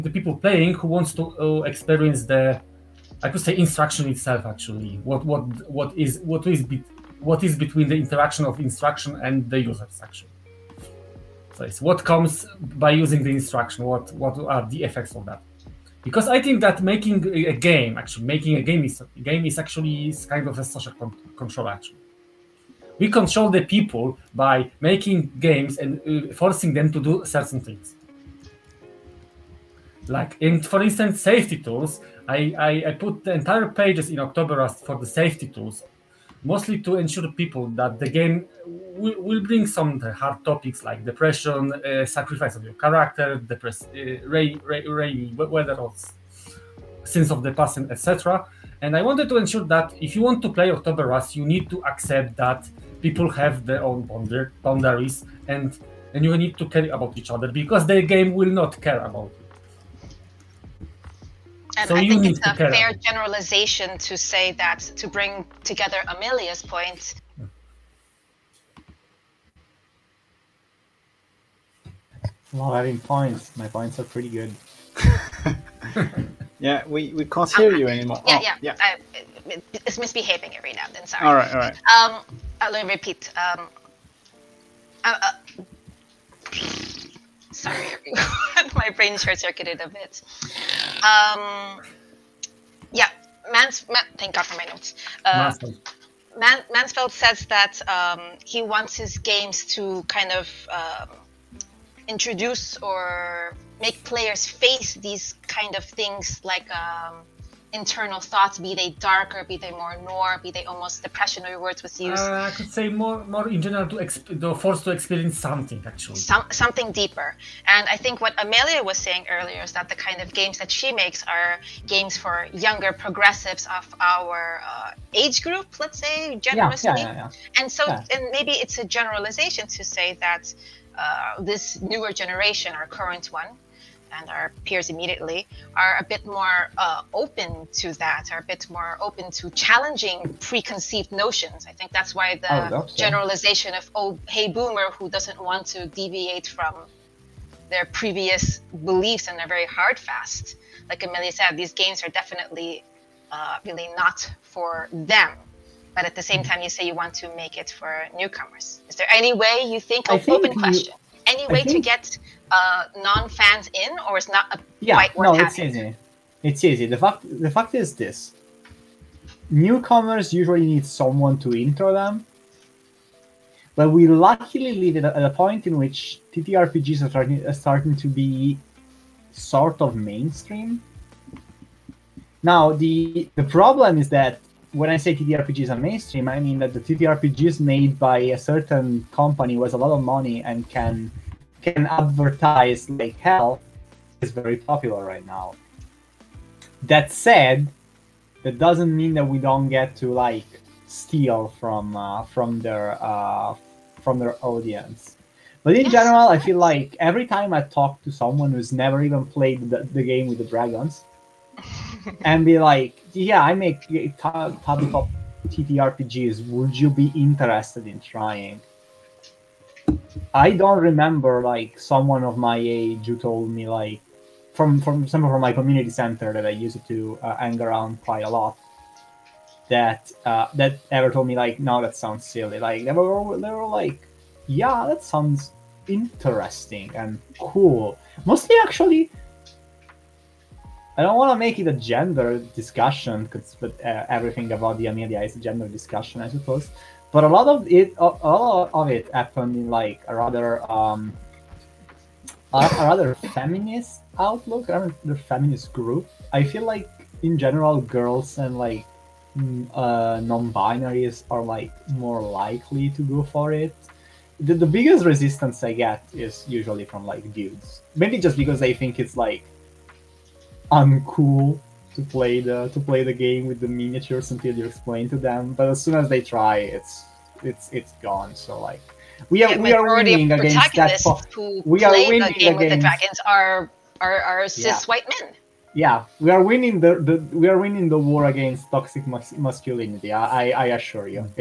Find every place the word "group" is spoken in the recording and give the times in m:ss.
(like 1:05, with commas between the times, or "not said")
2:05, 4:15.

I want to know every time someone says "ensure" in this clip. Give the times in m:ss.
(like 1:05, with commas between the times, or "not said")
0:36, 0:49.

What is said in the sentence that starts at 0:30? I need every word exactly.
Like in, for instance, safety tools.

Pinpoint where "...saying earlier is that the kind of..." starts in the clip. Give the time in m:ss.
1:58.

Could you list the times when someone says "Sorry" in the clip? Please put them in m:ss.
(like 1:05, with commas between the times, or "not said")
1:21, 1:27.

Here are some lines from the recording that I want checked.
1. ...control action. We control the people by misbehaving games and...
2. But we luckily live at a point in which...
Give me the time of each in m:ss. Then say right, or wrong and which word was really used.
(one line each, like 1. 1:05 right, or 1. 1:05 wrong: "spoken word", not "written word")
1. 0:21 wrong: "making", not "misbehaving"
2. 2:53 right.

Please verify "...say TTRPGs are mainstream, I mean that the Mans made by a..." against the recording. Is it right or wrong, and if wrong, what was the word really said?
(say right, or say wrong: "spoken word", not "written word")
wrong: "TTRPGs", not "Mans".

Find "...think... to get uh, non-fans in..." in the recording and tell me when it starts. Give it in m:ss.
2:41.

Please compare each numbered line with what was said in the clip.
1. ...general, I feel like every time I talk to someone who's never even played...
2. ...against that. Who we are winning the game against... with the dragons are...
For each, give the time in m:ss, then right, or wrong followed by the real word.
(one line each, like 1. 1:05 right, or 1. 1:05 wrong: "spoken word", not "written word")
1. 3:25 right
2. 4:40 right.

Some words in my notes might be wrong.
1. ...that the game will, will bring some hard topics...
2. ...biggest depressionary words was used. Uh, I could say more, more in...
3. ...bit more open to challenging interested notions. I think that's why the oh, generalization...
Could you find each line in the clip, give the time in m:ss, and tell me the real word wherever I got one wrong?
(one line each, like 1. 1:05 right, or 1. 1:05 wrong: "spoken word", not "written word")
1. 0:37 right
2. 1:50 wrong: "almost", not "biggest"
3. 2:18 wrong: "preconceived", not "interested".